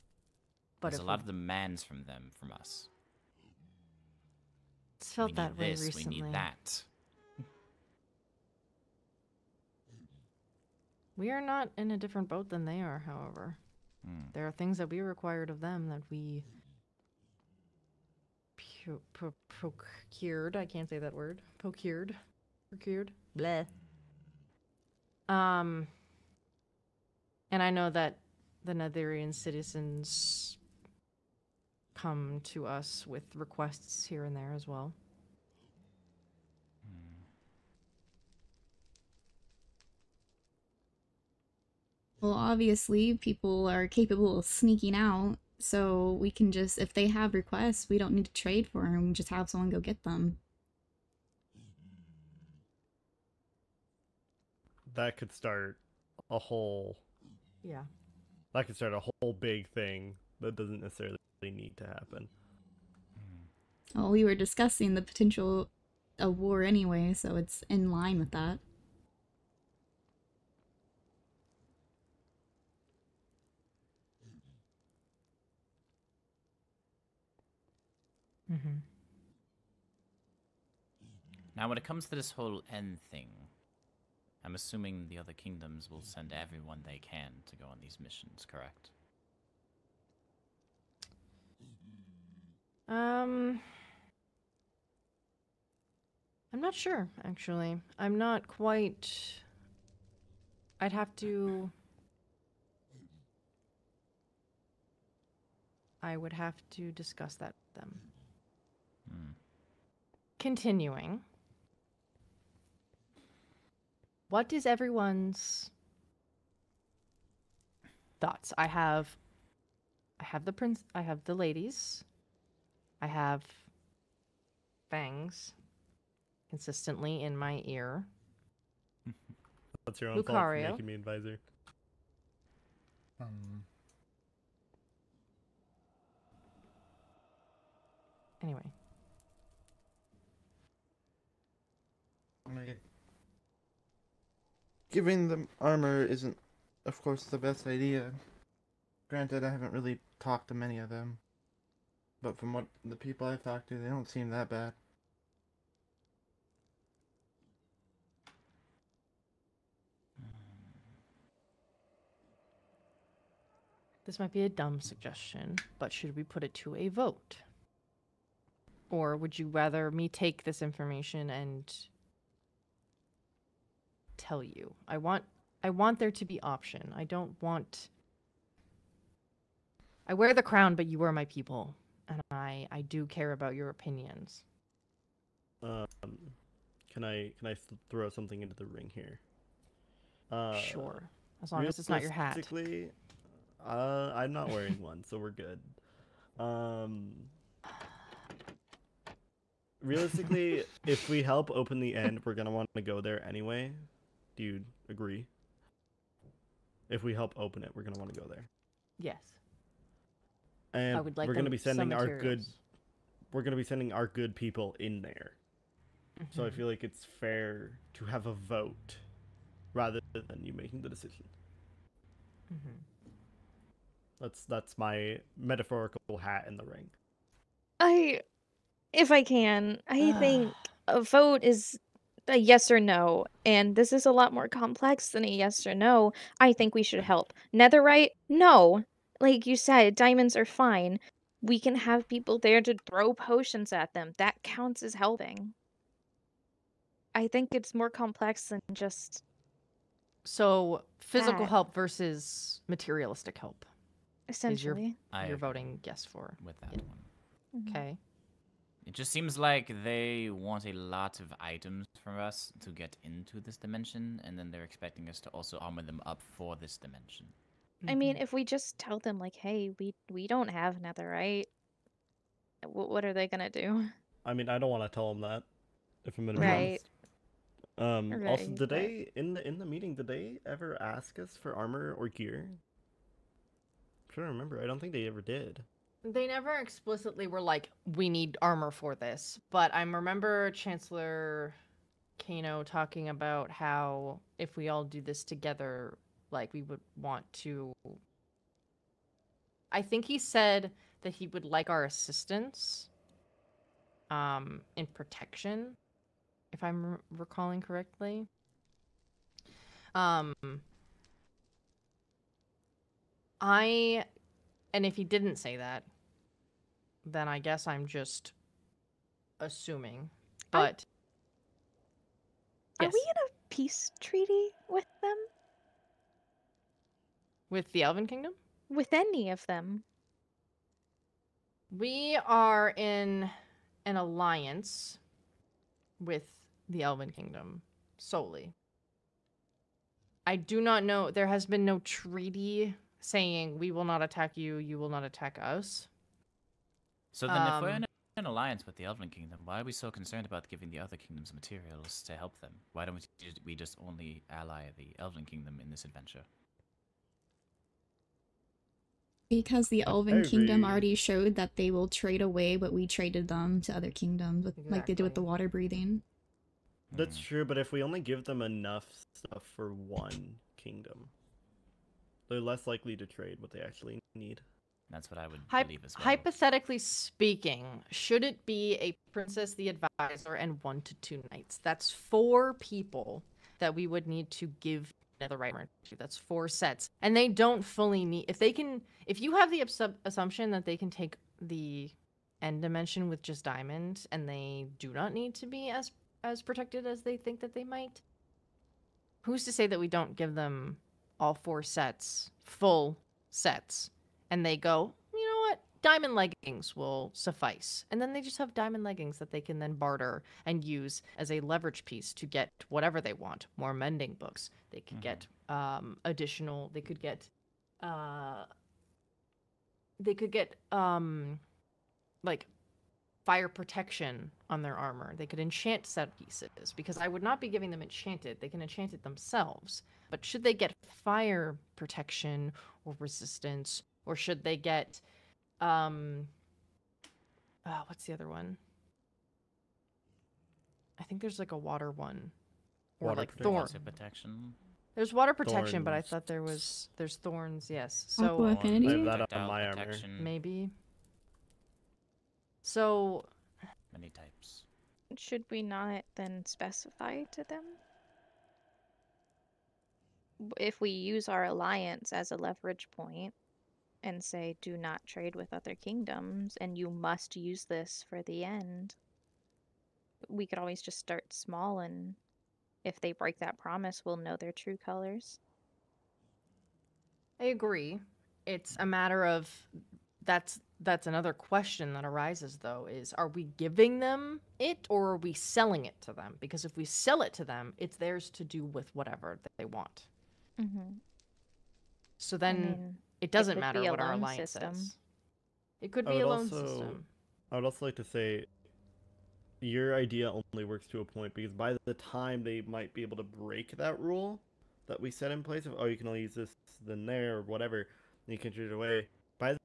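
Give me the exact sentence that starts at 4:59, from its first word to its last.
I think he said that he would like our assistance um, in protection, if I'm re- recalling correctly.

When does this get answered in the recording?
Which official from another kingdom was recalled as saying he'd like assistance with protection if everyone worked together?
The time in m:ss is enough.
4:50.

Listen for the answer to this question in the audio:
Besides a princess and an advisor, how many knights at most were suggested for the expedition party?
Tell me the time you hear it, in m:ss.
6:20.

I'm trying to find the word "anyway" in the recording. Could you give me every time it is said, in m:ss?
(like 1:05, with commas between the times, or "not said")
1:06, 2:18, 3:23.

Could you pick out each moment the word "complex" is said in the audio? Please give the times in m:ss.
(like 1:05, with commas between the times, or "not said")
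3:54, 4:07.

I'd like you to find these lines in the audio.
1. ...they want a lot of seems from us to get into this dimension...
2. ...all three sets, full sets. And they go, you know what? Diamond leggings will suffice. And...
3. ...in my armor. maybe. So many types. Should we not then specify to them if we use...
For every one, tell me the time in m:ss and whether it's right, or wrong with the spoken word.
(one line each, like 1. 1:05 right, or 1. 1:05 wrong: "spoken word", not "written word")
1. 4:19 wrong: "items", not "seems"
2. 6:41 wrong: "four", not "three"
3. 7:29 right.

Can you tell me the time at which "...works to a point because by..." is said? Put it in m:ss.
8:20.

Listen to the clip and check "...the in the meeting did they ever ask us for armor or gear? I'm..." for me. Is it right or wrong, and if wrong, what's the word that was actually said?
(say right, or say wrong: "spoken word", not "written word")
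right.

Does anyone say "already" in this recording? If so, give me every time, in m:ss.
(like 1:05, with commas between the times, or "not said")
6:00.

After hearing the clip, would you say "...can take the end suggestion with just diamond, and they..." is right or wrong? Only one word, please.
wrong.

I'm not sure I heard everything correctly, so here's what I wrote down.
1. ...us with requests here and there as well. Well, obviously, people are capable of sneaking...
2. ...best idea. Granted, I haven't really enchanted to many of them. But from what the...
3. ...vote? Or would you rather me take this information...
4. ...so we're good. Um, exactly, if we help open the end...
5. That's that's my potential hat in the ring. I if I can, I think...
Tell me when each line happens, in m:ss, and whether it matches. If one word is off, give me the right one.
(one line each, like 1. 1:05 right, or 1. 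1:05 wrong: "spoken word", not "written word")
1. 0:32 right
2. 2:27 wrong: "talked", not "enchanted"
3. 2:46 right
4. 3:15 wrong: "realistically", not "exactly"
5. 3:44 wrong: "metaphorical", not "potential".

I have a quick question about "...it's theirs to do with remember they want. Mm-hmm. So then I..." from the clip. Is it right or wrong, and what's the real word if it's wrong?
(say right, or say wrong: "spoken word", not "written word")
wrong: "whatever", not "remember".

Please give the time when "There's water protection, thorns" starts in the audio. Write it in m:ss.
7:24.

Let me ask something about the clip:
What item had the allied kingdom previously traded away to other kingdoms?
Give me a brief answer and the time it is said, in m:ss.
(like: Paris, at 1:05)
water breathing, at 6:05.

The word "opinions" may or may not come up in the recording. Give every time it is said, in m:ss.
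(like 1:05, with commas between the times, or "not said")
3:03.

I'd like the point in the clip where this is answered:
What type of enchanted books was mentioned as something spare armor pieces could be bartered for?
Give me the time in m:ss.
6:53.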